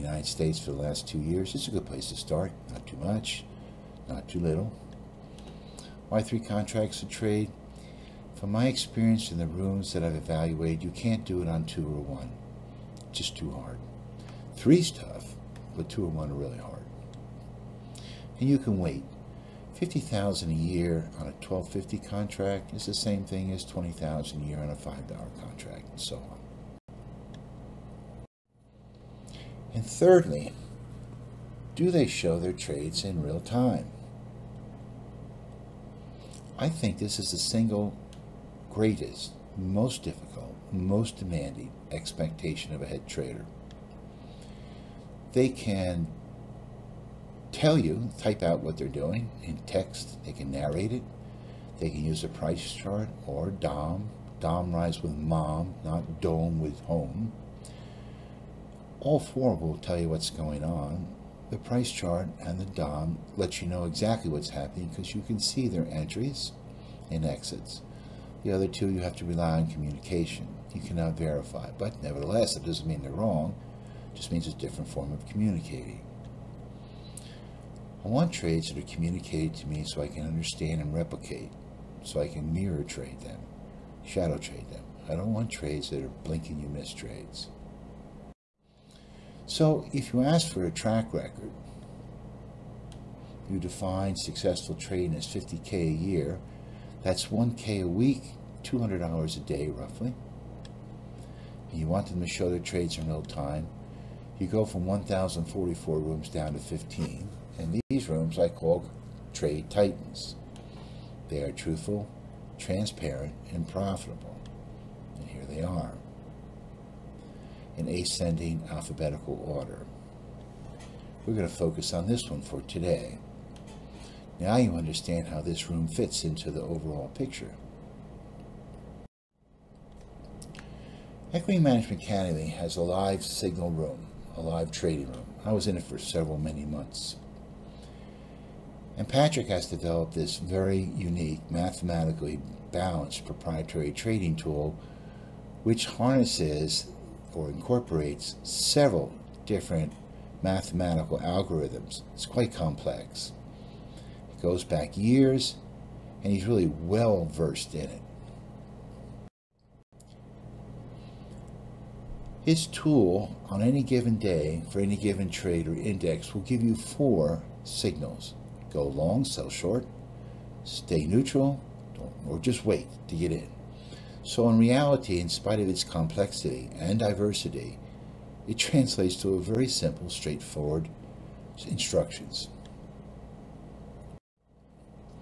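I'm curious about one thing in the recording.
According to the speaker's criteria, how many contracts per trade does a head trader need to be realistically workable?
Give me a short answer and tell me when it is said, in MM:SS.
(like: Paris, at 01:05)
3, at 00:06.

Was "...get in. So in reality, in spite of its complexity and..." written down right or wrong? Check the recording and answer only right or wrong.
right.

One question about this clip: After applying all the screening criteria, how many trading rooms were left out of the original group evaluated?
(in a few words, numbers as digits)
15.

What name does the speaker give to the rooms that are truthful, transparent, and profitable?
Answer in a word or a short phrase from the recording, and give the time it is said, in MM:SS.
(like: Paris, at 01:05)
trade titans, at 01:49.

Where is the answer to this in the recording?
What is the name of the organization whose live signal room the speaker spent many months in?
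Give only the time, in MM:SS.
02:11.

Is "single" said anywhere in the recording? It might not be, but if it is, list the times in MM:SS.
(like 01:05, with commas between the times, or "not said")
00:37.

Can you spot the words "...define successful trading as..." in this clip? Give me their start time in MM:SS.
01:33.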